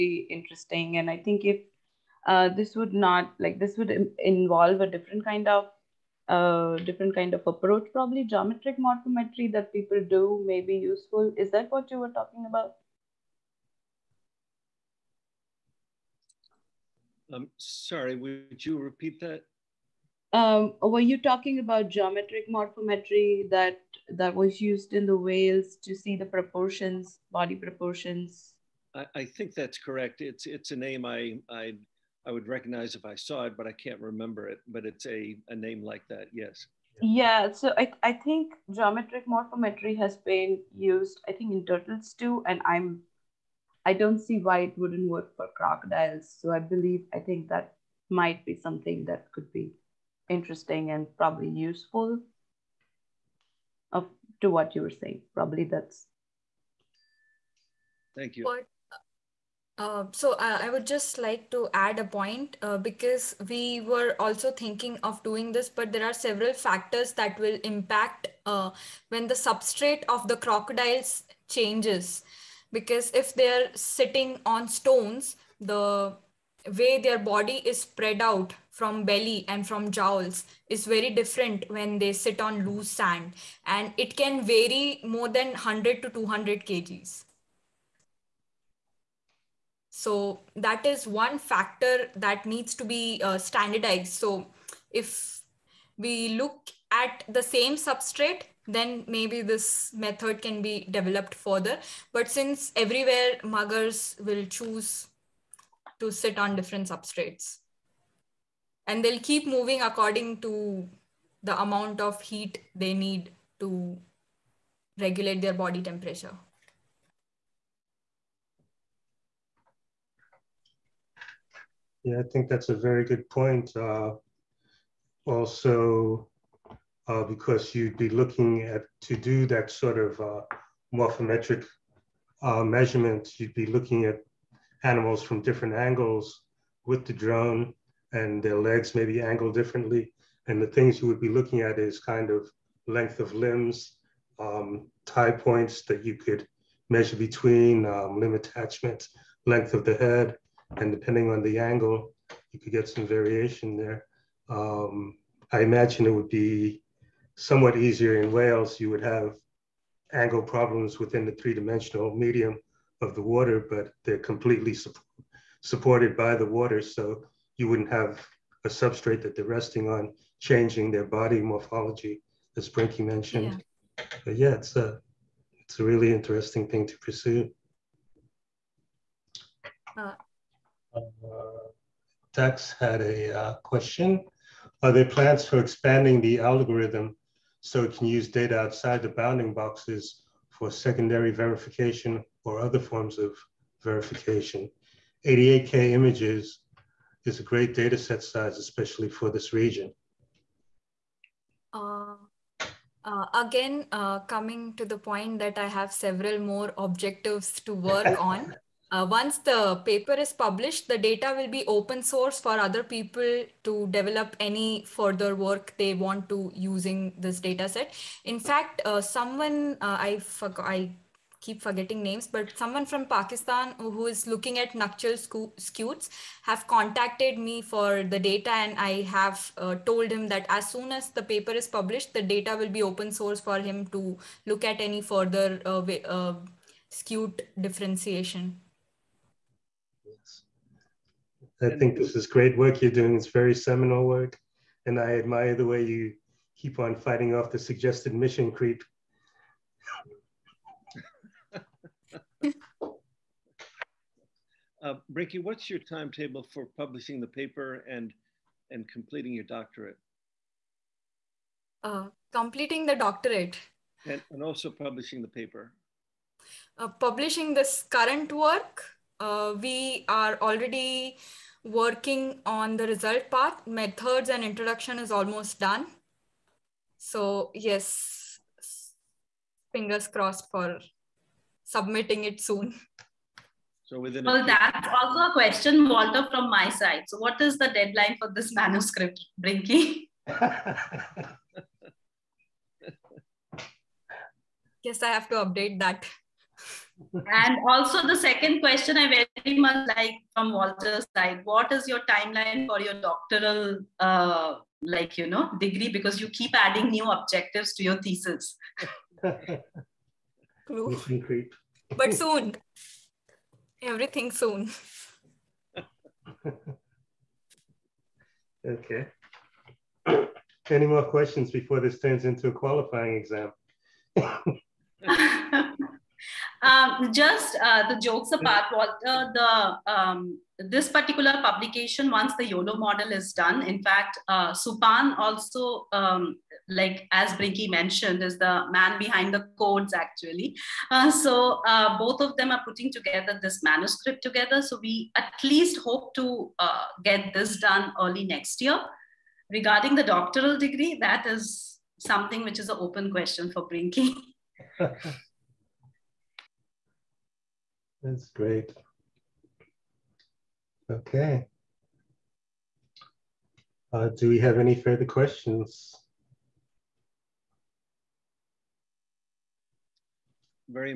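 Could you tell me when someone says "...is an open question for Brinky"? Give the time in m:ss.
5:52.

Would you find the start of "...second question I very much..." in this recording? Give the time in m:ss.
4:58.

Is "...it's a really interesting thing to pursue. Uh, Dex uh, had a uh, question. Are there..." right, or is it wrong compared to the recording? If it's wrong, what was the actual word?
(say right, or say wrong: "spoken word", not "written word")
right.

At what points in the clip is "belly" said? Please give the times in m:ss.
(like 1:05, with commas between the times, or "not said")
1:19.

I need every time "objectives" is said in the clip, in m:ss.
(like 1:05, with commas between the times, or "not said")
3:26, 5:07.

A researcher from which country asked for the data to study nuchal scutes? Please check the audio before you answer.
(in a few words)
Pakistan.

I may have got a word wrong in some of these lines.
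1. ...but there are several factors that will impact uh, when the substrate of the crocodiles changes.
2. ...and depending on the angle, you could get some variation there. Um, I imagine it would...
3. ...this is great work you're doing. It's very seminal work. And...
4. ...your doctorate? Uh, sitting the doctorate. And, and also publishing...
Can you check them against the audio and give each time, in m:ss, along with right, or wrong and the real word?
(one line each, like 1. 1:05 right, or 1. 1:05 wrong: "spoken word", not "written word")
1. 1:05 right
2. 2:30 right
3. 4:01 right
4. 4:19 wrong: "completing", not "sitting".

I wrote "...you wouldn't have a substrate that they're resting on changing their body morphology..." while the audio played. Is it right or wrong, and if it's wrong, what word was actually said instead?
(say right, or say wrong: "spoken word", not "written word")
right.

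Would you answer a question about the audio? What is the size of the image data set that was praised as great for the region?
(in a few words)
88K images.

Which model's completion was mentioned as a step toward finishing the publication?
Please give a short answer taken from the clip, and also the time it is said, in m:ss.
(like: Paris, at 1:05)
YOLO, at 5:32.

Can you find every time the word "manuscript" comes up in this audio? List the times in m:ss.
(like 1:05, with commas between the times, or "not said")
4:48, 5:43.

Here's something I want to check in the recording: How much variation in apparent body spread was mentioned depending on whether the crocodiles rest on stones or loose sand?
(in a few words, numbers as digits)
100 to 200 kg.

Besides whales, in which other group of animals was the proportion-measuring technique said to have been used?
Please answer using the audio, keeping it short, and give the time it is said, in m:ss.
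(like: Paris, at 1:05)
turtles, at 0:41.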